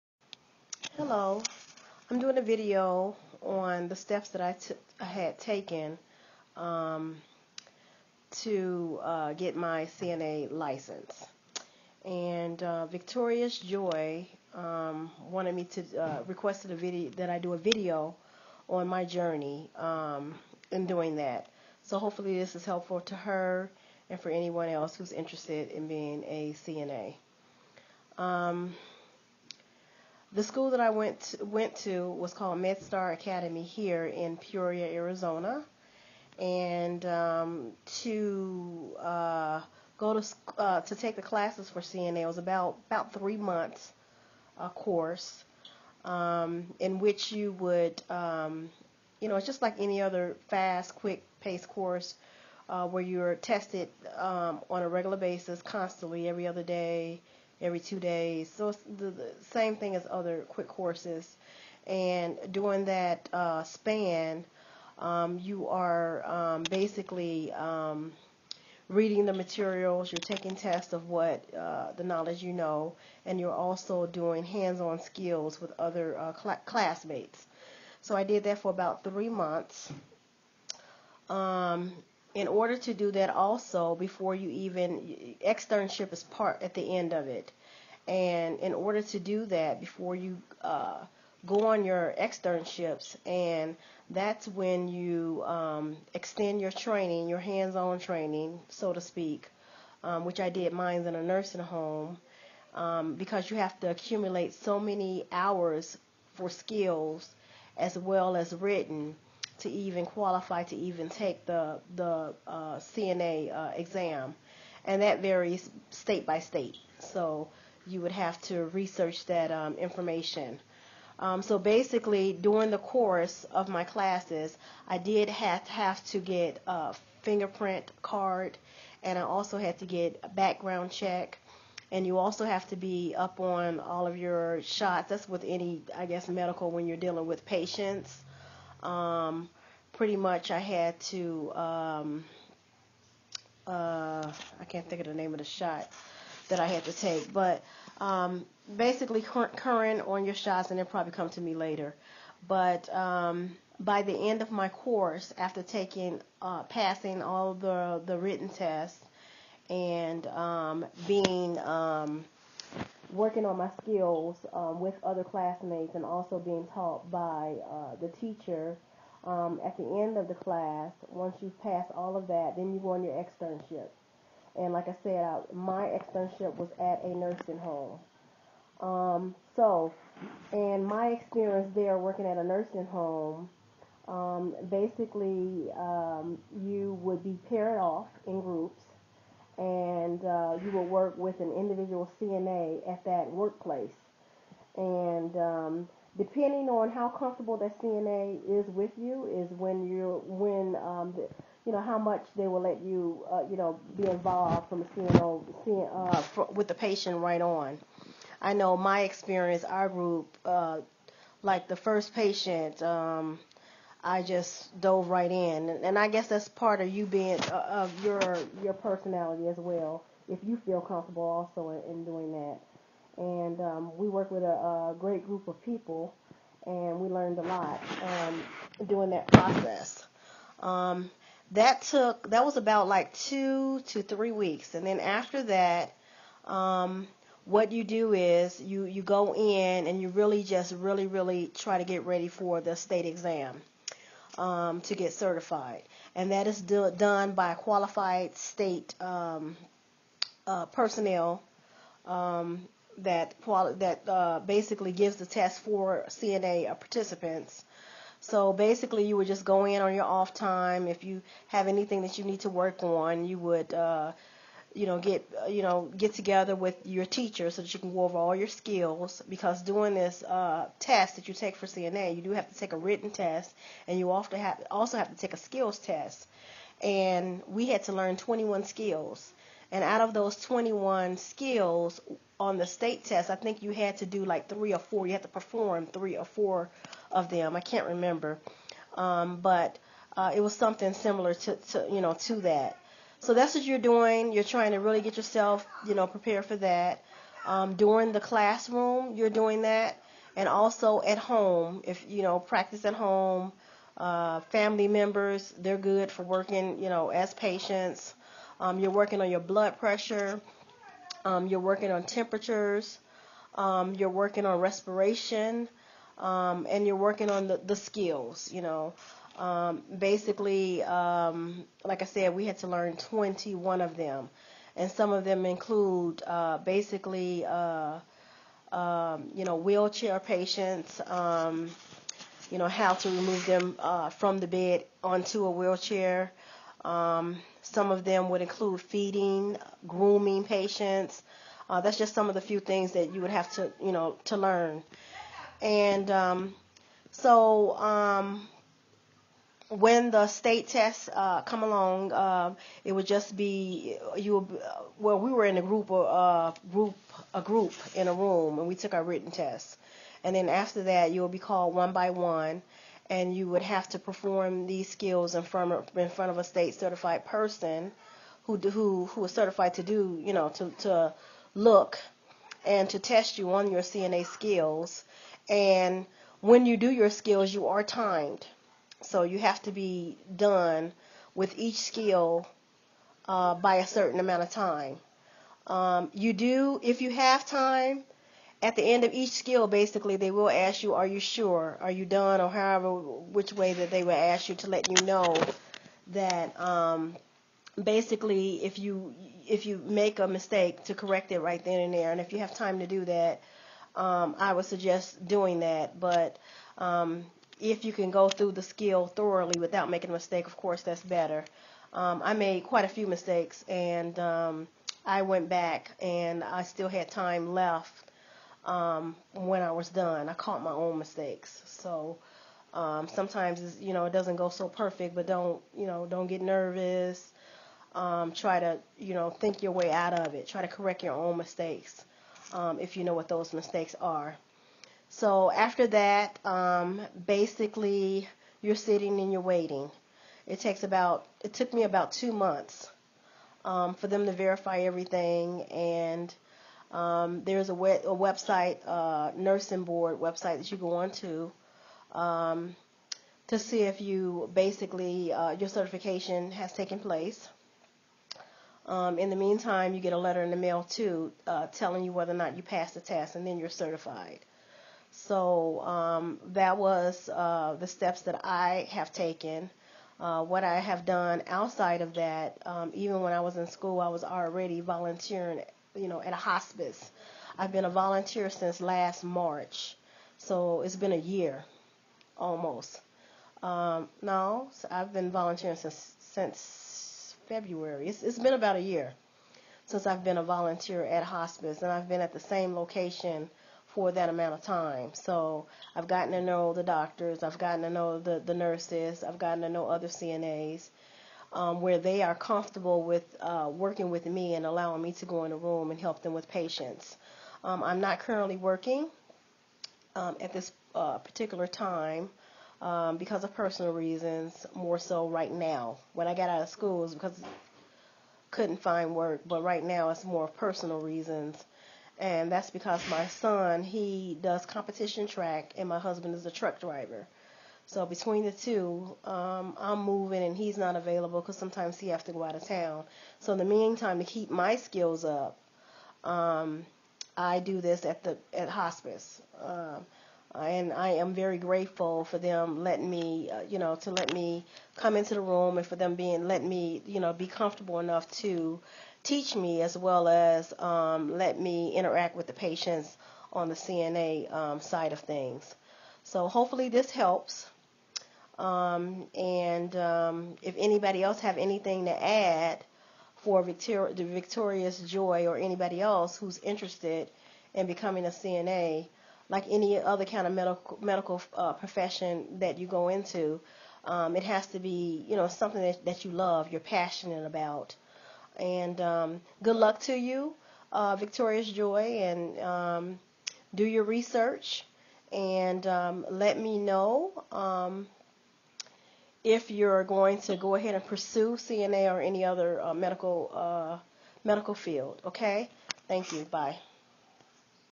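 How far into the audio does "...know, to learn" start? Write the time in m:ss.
5:43.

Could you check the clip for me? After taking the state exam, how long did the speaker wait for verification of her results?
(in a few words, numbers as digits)
2 months.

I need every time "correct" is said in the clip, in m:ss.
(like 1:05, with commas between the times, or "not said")
6:40, 7:10.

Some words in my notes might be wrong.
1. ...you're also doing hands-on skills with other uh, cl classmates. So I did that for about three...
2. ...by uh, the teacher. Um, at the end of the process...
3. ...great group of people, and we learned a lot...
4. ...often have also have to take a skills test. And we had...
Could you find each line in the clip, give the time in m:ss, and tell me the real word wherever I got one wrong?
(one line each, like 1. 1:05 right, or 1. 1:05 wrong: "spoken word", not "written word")
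1. 1:13 right
2. 2:47 wrong: "class", not "process"
3. 3:44 right
4. 4:34 right.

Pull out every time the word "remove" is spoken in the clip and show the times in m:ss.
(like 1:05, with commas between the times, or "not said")
5:33.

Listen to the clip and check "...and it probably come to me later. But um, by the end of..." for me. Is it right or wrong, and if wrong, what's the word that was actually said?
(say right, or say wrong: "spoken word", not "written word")
right.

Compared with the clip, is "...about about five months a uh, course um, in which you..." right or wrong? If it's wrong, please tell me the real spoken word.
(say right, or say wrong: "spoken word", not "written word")
wrong: "three", not "five".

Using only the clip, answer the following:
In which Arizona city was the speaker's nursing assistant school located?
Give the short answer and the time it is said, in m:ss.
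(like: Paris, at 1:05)
Peoria, at 0:34.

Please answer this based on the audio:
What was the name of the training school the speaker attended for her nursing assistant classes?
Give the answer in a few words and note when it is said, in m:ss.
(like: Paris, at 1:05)
MedStar Academy, at 0:32.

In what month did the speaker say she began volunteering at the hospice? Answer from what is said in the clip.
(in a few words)
February.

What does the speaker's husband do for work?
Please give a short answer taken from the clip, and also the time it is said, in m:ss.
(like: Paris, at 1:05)
truck driver, at 8:46.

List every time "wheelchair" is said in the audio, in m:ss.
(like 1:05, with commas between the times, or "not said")
5:29, 5:35.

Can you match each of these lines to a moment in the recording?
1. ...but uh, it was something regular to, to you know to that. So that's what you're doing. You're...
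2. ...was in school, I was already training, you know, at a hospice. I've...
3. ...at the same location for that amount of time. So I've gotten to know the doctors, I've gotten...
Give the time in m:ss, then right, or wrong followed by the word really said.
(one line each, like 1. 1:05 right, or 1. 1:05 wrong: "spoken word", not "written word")
1. 4:49 wrong: "similar", not "regular"
2. 7:53 wrong: "volunteering", not "training"
3. 8:12 right.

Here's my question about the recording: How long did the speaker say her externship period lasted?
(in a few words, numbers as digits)
2 to 3 weeks.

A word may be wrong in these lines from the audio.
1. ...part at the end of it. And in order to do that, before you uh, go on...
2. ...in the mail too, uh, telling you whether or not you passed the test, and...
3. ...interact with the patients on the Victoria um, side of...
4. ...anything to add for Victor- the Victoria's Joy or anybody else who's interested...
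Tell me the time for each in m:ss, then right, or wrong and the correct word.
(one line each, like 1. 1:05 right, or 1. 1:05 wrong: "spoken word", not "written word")
1. 1:26 right
2. 7:40 right
3. 9:11 wrong: "CNA", not "Victoria"
4. 9:21 right.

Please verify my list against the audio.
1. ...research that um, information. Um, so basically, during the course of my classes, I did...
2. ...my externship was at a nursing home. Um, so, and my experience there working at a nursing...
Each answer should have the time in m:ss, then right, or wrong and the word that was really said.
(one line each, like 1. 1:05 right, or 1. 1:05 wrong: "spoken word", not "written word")
1. 1:58 right
2. 2:55 right.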